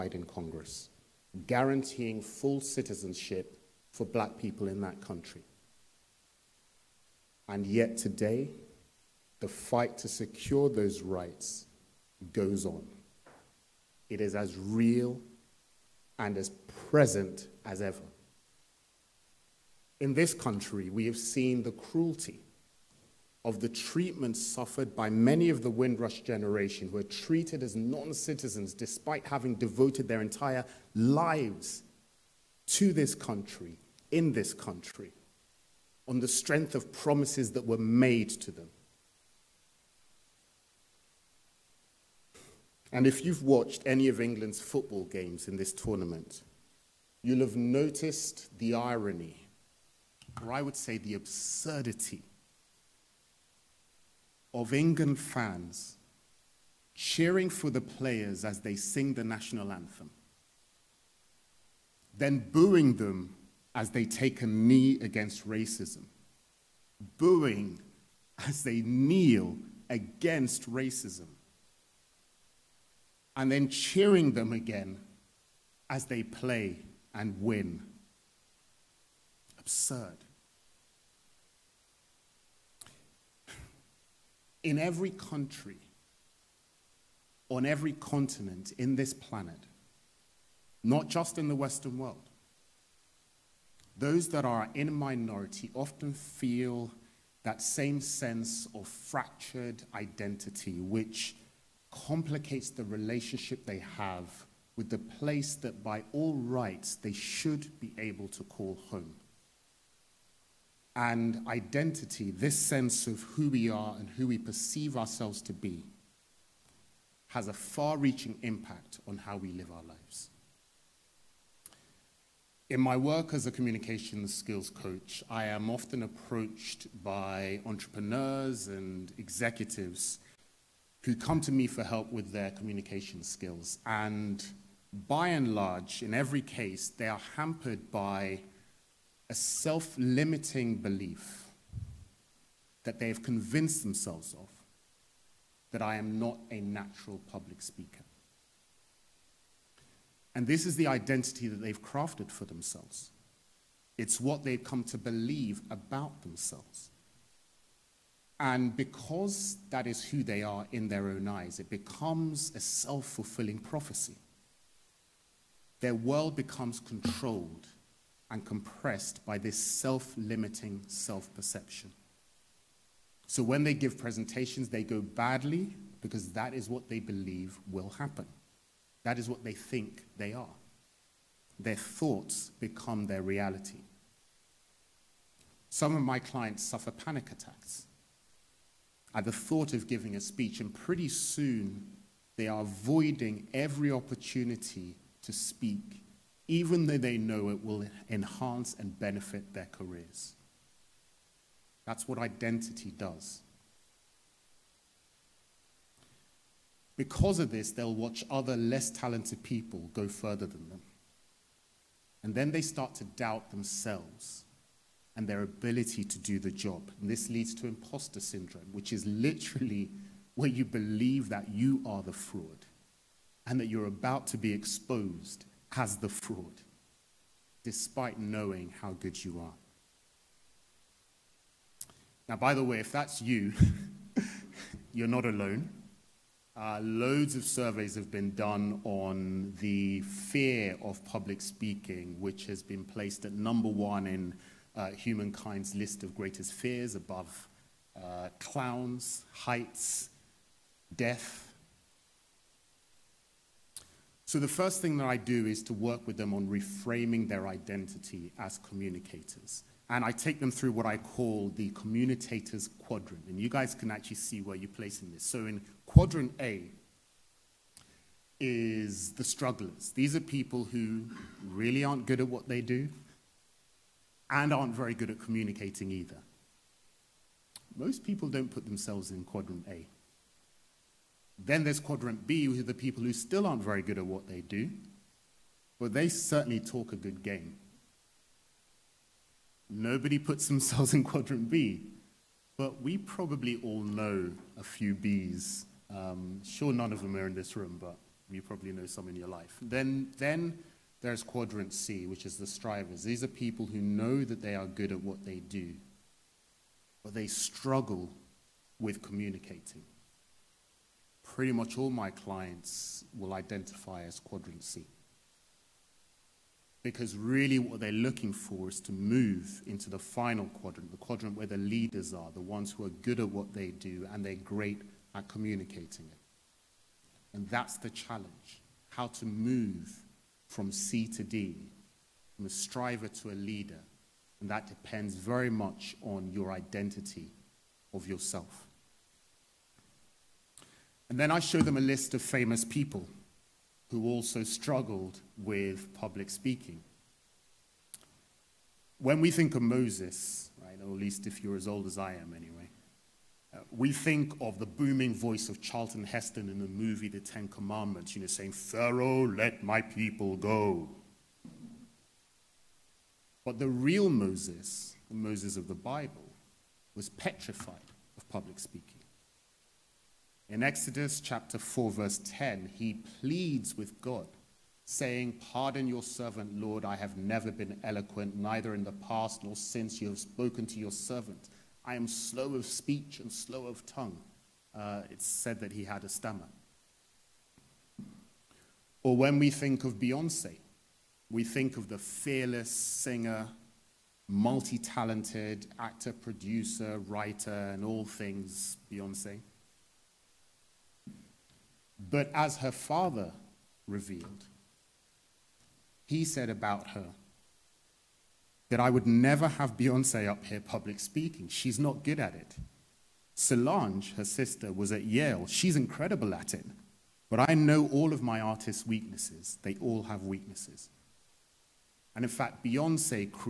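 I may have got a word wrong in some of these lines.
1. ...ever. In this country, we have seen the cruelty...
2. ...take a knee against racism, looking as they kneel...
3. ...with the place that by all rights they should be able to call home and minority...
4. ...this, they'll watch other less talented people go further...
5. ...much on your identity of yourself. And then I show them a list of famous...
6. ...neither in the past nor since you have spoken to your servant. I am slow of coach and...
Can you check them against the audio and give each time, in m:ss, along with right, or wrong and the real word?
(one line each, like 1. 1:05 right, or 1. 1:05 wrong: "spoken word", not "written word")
1. 0:17 right
2. 1:04 wrong: "booing", not "looking"
3. 1:44 wrong: "identity", not "minority"
4. 3:27 right
5. 5:35 right
6. 6:18 wrong: "speech", not "coach".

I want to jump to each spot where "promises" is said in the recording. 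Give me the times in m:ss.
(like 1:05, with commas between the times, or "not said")
0:36.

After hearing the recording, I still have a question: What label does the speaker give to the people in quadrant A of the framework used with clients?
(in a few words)
strugglers.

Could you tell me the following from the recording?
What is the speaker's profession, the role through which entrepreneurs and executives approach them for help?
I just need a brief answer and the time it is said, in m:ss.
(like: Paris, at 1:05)
communications skills coach, at 2:03.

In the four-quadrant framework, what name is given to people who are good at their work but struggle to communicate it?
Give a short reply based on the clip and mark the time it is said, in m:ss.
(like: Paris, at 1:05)
strivers, at 5:02.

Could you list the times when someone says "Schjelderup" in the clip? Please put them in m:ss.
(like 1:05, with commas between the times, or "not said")
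not said.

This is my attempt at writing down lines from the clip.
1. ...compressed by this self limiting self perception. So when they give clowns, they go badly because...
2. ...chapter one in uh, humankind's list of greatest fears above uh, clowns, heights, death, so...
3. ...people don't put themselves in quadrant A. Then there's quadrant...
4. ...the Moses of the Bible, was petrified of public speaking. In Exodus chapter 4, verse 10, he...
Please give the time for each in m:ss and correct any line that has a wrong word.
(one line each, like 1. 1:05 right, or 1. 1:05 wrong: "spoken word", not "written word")
1. 2:48 wrong: "presentations", not "clowns"
2. 4:03 wrong: "number", not "chapter"
3. 4:38 right
4. 6:05 right.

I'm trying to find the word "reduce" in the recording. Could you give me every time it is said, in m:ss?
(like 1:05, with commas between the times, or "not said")
not said.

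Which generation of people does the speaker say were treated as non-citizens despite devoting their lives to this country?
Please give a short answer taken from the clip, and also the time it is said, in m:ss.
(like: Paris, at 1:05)
Windrush generation, at 0:25.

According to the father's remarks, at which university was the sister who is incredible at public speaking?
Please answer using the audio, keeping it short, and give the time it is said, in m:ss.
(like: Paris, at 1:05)
Yale, at 6:55.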